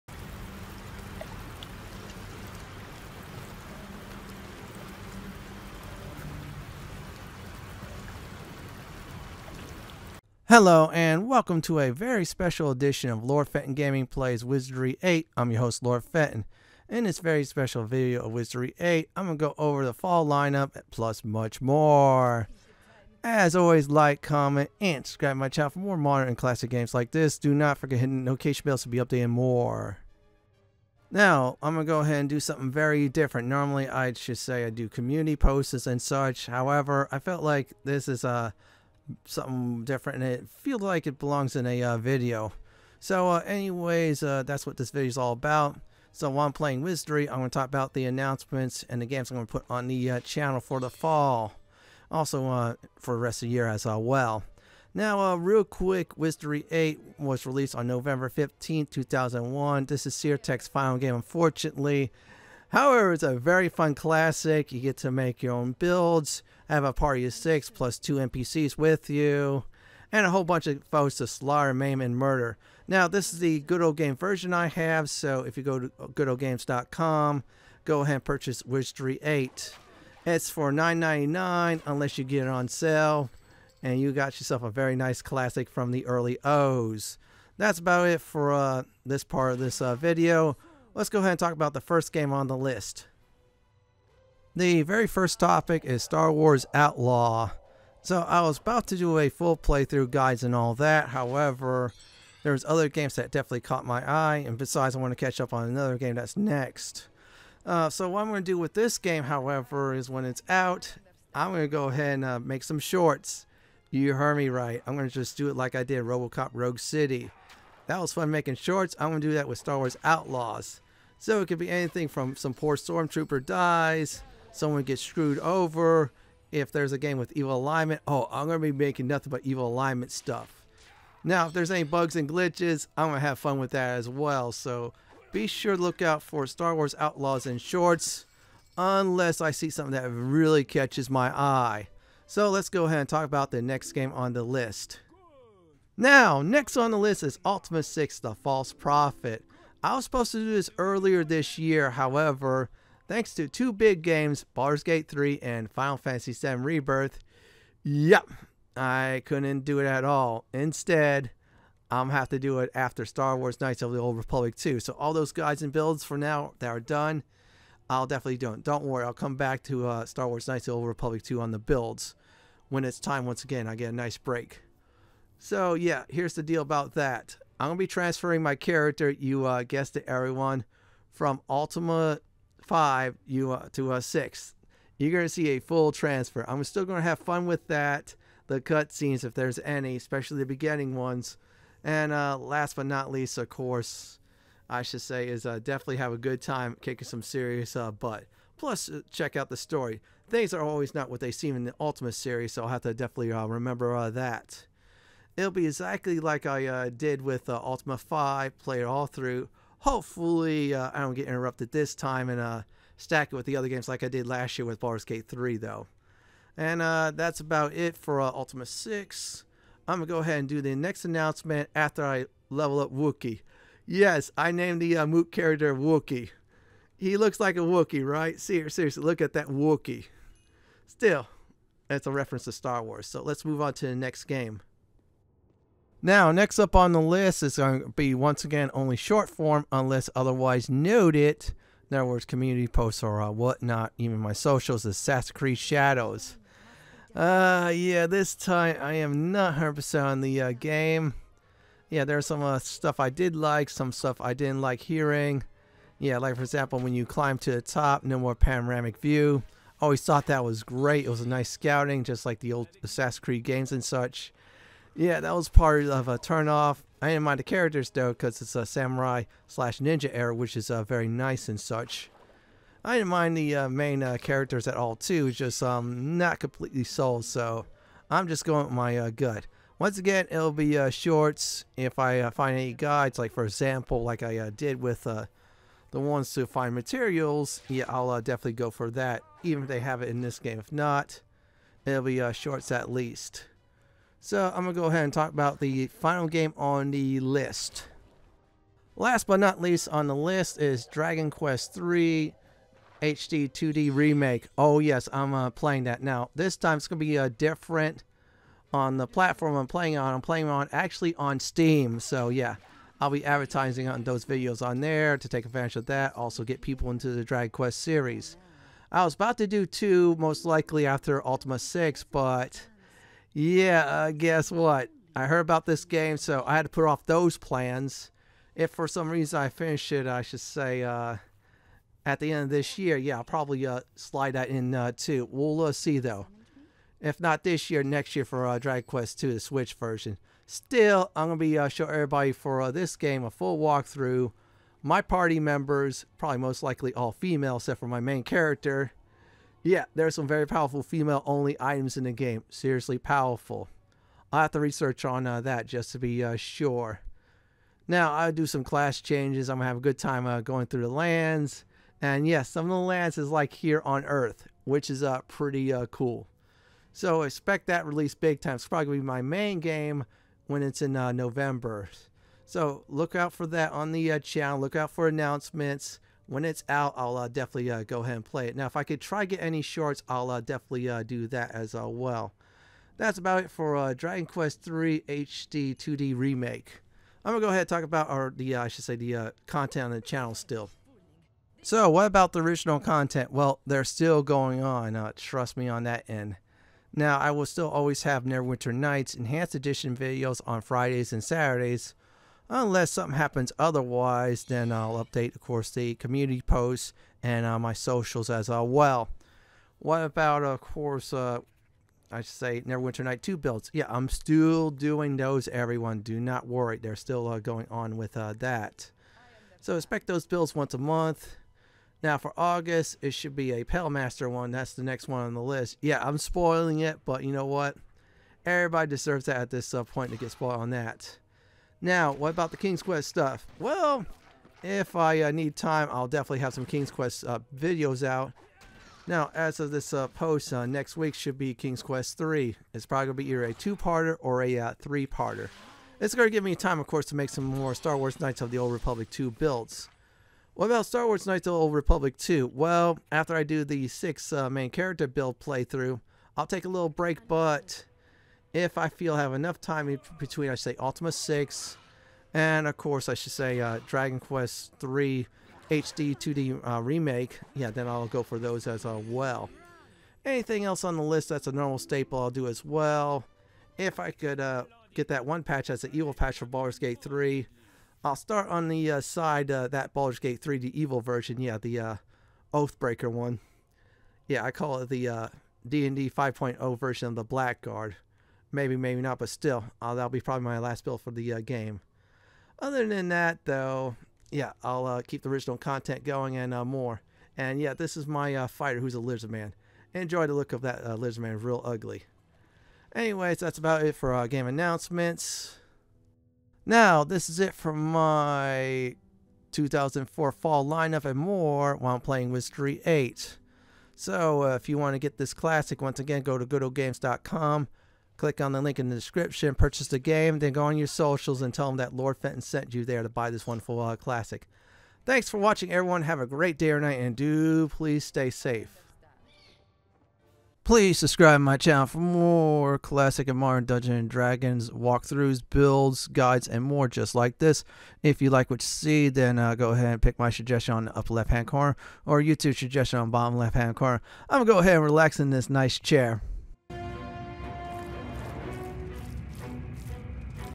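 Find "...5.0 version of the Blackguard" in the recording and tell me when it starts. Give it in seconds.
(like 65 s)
486 s.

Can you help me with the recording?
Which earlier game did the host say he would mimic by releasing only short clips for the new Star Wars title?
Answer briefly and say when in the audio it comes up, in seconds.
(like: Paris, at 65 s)
Robocop Rogue City, at 116 s.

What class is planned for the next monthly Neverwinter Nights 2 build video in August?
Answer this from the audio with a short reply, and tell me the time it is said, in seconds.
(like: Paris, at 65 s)
Pale Master, at 423 s.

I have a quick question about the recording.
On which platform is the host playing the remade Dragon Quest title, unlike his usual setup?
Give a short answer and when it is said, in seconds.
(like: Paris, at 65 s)
Steam, at 311 s.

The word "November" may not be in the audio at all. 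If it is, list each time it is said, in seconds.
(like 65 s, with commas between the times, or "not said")
57 s, 371 s.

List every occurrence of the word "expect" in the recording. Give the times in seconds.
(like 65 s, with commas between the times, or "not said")
367 s, 419 s.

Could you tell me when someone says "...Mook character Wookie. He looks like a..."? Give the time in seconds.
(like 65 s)
225 s.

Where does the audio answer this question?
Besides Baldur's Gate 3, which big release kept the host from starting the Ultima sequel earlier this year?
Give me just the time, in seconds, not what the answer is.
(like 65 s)
155 s.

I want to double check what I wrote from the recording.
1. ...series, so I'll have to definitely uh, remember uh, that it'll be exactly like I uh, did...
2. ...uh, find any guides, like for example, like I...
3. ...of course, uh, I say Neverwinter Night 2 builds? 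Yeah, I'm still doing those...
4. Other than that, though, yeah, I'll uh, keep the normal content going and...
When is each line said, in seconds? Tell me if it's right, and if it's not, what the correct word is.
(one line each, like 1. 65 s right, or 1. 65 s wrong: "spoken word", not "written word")
1. 202 s right
2. 282 s right
3. 410 s right
4. 492 s wrong: "original", not "normal".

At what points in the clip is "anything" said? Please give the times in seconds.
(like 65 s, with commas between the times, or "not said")
121 s, 470 s.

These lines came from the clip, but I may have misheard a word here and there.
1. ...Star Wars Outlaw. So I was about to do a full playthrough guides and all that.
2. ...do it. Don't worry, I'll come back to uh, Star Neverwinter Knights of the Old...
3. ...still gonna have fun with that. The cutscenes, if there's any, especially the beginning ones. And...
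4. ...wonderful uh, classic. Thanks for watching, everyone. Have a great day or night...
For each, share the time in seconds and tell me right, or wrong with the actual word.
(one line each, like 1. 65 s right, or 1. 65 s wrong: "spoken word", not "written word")
1. 96 s right
2. 168 s wrong: "Wars", not "Neverwinter"
3. 186 s right
4. 523 s right.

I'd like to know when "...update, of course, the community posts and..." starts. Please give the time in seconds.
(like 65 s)
405 s.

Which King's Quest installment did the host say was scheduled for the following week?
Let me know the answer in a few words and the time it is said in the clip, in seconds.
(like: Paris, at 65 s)
King's Quest 3, at 441 s.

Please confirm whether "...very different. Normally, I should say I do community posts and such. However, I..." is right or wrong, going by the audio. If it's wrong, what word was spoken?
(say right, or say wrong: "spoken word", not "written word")
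right.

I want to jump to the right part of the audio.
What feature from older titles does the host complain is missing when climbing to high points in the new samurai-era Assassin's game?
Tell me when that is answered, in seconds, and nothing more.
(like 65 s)
258 s.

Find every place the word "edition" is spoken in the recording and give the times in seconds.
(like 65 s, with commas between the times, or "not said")
12 s, 399 s.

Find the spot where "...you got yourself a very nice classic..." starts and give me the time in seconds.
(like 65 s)
83 s.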